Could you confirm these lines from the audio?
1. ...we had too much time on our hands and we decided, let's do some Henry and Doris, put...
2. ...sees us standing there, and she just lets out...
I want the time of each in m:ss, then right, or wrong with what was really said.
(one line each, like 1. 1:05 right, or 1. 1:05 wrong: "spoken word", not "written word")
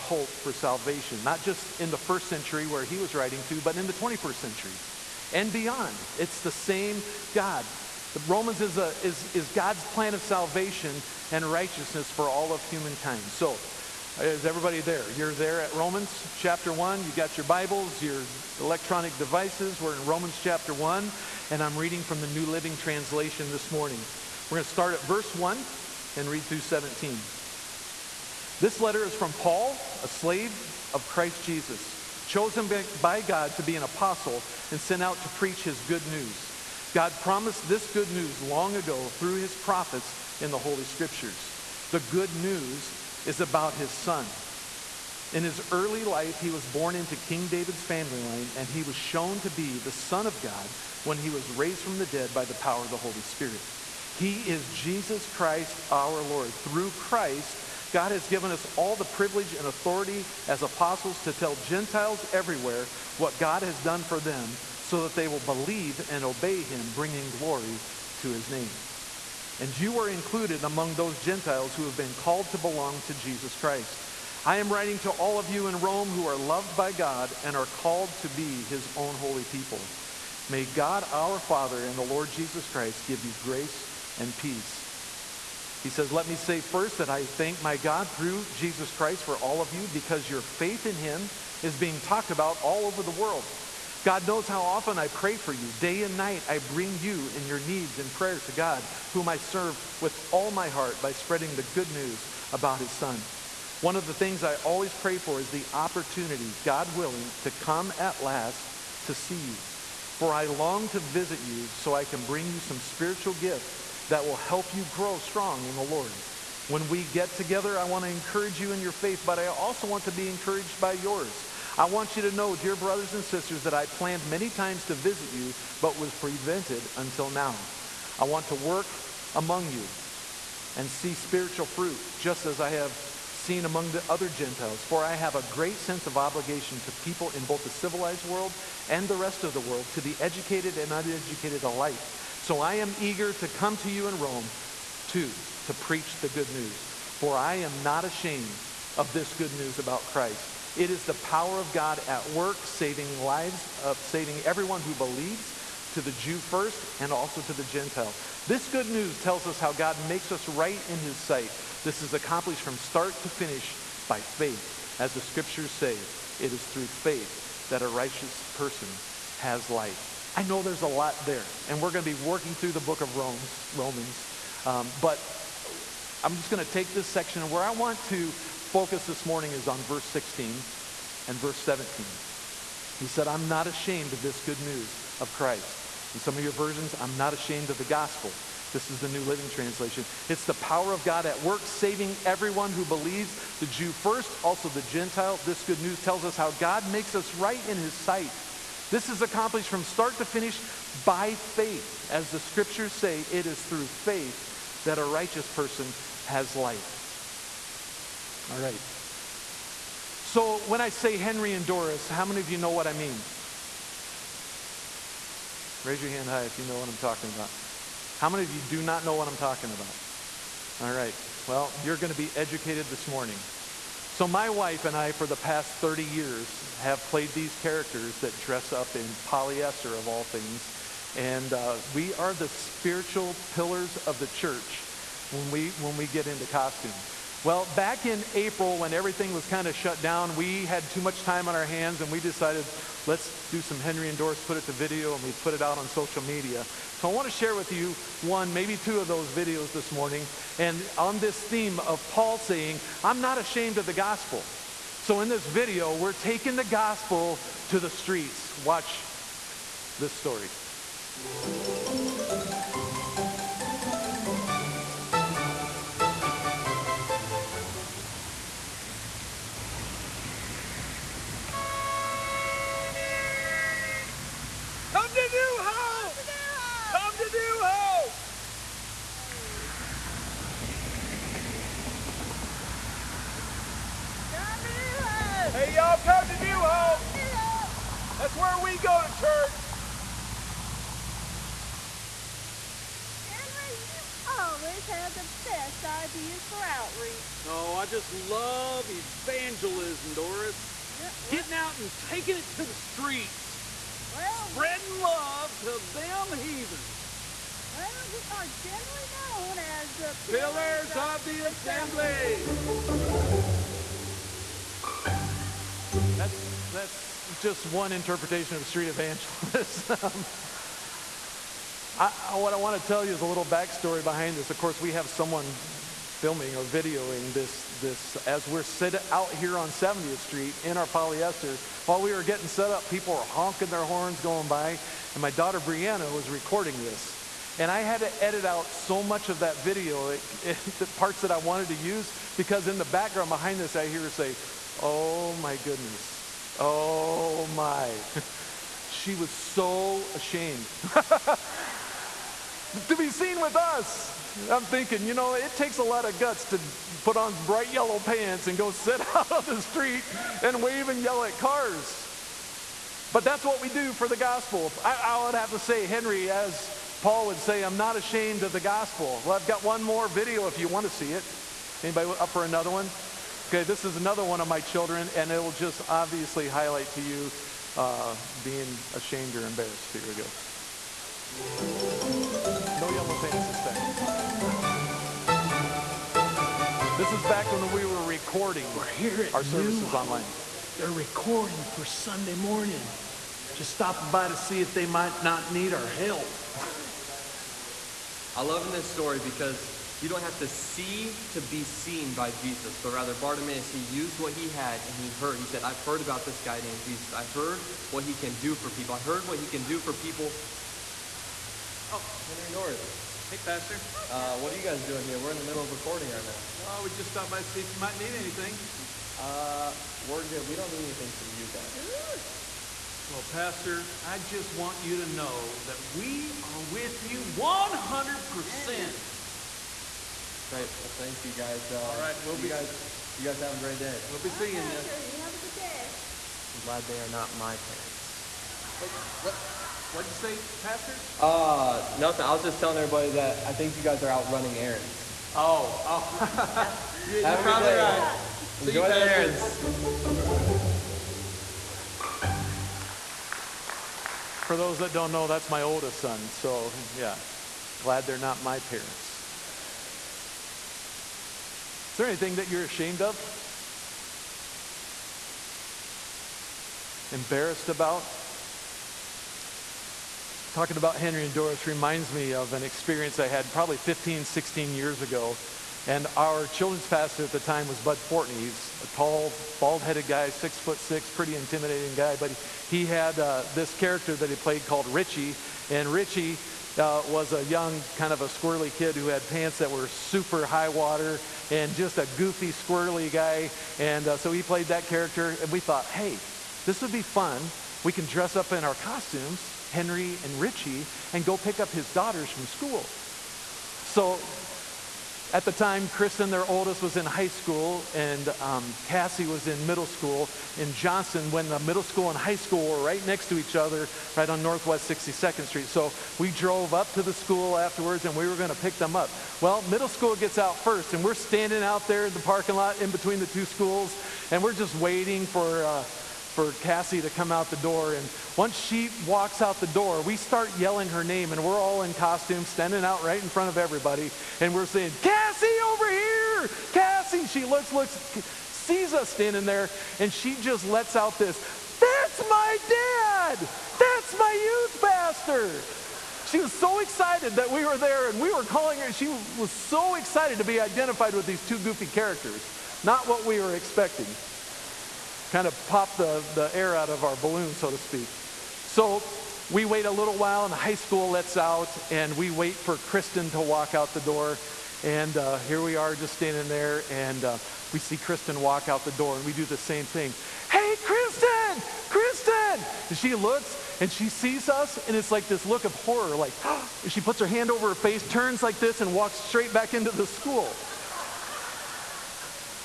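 1. 4:00 right
2. 8:58 right.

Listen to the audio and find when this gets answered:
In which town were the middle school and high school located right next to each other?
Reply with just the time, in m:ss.
8:30.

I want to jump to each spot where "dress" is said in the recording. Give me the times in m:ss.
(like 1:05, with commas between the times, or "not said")
3:48, 8:18.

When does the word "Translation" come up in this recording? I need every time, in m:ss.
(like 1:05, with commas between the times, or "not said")
0:22, 3:09.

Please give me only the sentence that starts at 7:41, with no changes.
Is there anything that you're ashamed of?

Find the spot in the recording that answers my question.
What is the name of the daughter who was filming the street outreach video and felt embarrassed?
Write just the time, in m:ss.
5:35.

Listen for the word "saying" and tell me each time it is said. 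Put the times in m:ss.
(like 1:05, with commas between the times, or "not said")
4:12, 8:54.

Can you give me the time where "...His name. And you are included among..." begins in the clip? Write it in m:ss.
1:08.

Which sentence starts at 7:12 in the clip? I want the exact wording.
Guys, you guys have a great day.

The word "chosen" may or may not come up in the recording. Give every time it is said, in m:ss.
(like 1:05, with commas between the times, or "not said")
0:32.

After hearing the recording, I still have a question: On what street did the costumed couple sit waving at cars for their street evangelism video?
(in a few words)
70th Street.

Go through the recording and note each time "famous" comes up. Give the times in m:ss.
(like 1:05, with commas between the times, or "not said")
not said.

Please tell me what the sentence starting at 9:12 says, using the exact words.
Not what we were expecting kind of pop the, the air out of our balloon, so to speak.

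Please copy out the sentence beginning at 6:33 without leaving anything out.
Just stopping by to see if they might not need our help.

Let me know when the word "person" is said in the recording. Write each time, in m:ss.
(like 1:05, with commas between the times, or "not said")
2:48, 3:25.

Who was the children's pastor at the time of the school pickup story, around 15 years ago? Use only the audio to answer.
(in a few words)
Bud Fortney.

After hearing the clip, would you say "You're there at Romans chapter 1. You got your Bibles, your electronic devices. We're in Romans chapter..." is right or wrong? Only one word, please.
right.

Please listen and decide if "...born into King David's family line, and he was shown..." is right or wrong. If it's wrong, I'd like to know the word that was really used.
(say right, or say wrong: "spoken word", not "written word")
right.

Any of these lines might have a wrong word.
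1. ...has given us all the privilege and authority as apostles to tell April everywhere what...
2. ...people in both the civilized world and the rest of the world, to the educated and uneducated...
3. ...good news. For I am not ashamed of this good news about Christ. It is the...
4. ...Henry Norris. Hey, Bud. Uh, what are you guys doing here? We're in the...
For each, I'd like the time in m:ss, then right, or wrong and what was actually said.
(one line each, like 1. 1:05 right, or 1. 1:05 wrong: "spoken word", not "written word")
1. 0:58 wrong: "Gentiles", not "April"
2. 2:16 right
3. 2:26 right
4. 6:52 wrong: "Pastor", not "Bud".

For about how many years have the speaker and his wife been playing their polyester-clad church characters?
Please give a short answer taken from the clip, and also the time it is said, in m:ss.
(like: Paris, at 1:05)
30, at 3:45.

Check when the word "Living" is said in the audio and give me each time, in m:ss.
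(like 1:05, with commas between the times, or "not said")
0:22, 3:09.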